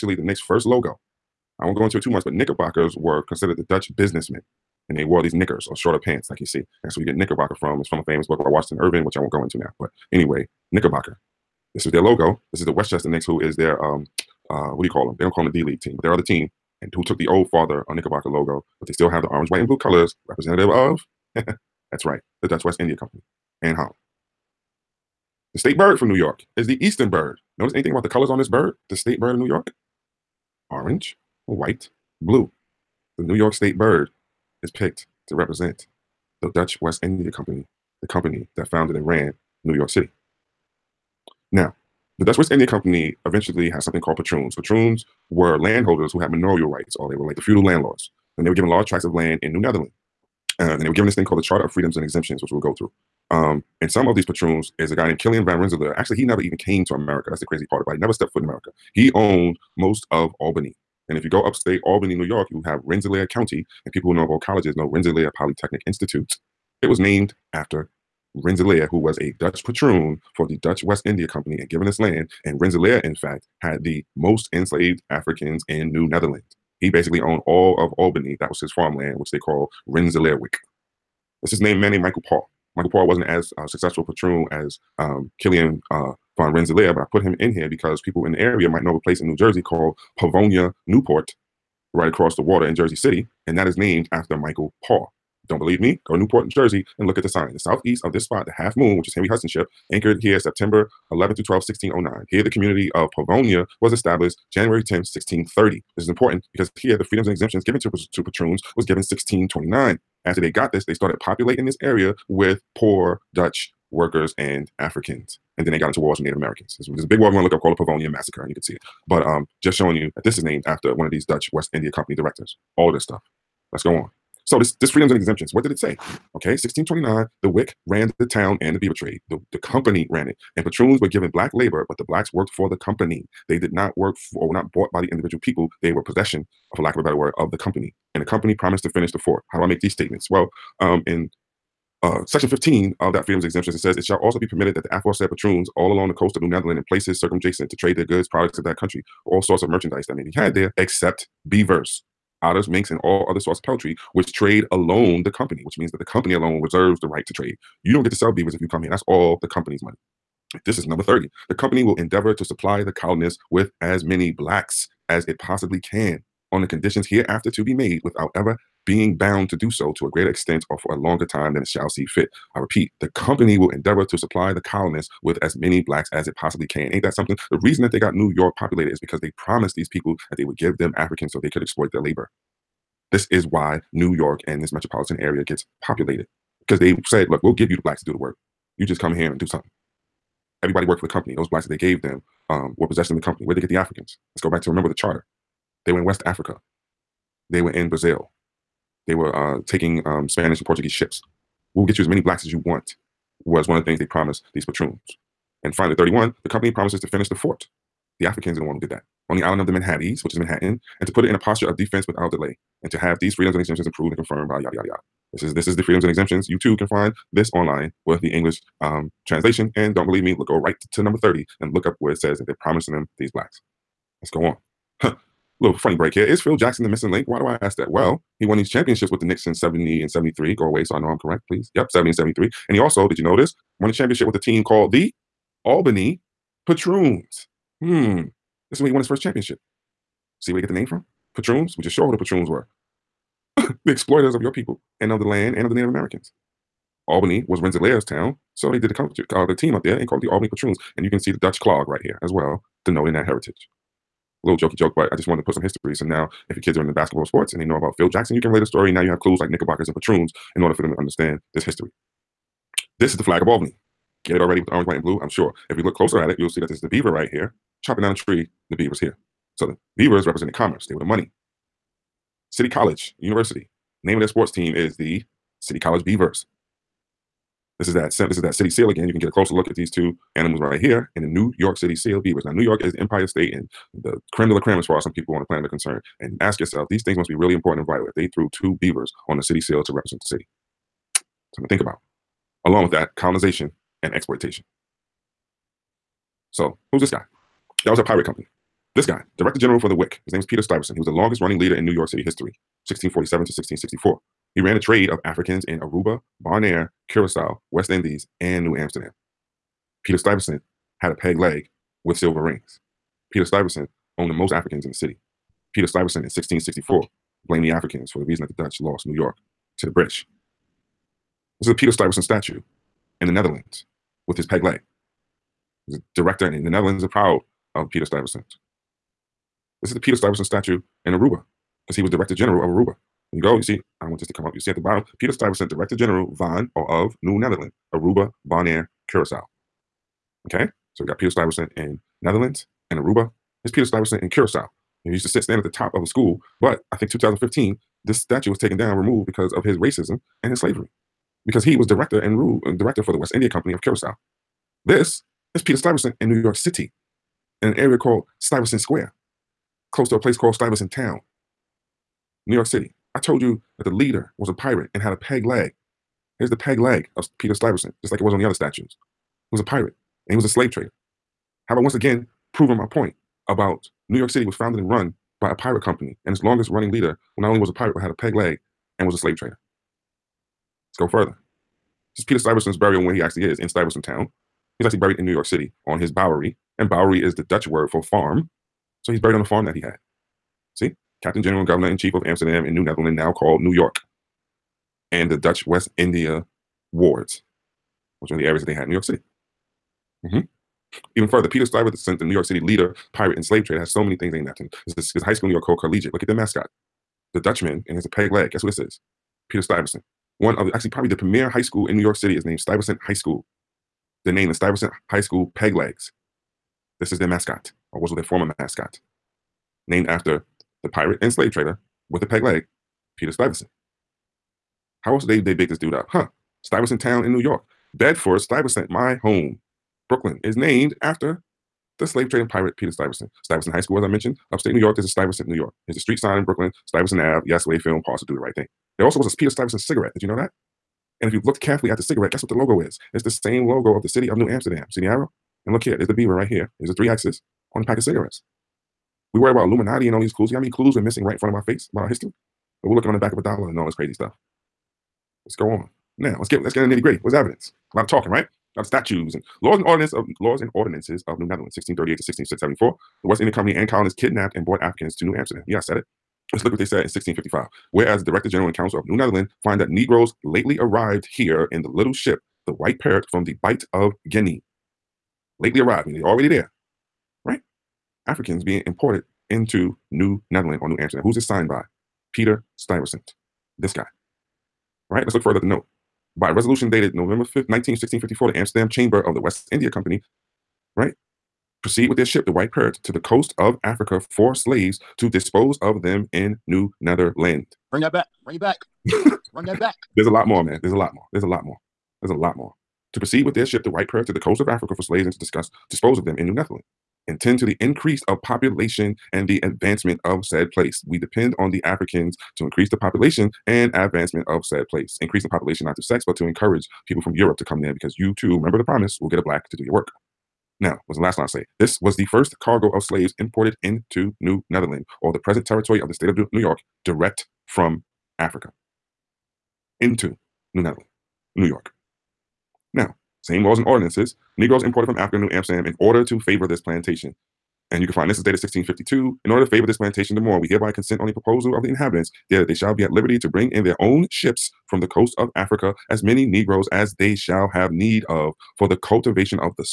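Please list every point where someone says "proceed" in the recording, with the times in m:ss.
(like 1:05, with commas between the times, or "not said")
8:11, 8:23.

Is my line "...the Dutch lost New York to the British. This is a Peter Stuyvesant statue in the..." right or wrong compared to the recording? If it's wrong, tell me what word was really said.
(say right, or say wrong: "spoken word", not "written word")
right.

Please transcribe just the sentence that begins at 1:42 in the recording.
Here, the community of Pavonia was established January 10, 1630.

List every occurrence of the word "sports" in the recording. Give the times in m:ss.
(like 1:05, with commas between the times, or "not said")
4:17, 4:34.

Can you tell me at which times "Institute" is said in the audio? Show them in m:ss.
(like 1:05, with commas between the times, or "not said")
1:05.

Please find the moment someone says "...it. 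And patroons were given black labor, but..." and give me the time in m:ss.
2:10.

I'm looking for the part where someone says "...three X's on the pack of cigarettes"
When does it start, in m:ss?
7:26.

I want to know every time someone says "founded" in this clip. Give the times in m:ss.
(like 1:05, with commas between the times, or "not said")
0:38, 6:14.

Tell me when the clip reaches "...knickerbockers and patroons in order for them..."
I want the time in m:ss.
4:19.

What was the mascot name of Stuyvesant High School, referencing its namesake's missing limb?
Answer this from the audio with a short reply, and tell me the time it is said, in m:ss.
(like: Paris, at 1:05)
Peg Legs, at 6:55.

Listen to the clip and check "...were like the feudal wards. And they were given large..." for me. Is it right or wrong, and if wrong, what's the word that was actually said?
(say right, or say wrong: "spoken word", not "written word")
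wrong: "landlords", not "wards".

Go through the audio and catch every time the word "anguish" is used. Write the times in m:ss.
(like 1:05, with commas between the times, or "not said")
not said.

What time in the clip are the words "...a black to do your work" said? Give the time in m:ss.
8:39.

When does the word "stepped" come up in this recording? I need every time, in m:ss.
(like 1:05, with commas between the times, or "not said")
0:58.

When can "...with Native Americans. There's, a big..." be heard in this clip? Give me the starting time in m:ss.
1:56.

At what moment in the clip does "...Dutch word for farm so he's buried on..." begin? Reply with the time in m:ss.
6:27.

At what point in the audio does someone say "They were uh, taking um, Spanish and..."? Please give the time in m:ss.
3:19.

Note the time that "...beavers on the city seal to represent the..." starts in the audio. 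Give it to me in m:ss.
4:48.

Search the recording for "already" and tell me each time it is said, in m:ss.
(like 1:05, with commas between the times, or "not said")
4:24, 7:56.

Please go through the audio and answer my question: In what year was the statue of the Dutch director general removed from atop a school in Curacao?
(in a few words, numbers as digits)
2015.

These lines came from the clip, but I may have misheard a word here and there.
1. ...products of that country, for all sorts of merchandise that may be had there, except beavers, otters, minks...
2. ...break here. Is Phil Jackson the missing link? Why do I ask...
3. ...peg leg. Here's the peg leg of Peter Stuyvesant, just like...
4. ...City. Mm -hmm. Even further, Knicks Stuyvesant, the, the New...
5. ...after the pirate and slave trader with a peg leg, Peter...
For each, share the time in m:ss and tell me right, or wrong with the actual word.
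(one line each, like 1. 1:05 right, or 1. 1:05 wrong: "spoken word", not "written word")
1. 2:28 right
2. 3:45 right
3. 6:05 right
4. 6:39 wrong: "Peter", not "Knicks"
5. 7:00 right.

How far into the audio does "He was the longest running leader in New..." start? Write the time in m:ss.
5:00.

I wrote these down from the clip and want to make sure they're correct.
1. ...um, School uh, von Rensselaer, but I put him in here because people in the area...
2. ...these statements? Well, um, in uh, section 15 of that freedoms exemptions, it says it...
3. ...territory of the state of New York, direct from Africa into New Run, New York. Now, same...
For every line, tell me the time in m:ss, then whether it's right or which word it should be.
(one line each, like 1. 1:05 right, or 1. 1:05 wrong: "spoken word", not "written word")
1. 1:24 wrong: "Killian", not "School"
2. 2:19 right
3. 8:45 wrong: "Netherland", not "Run".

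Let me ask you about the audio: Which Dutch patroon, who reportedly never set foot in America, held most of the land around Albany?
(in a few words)
Killian Van Rensselaer.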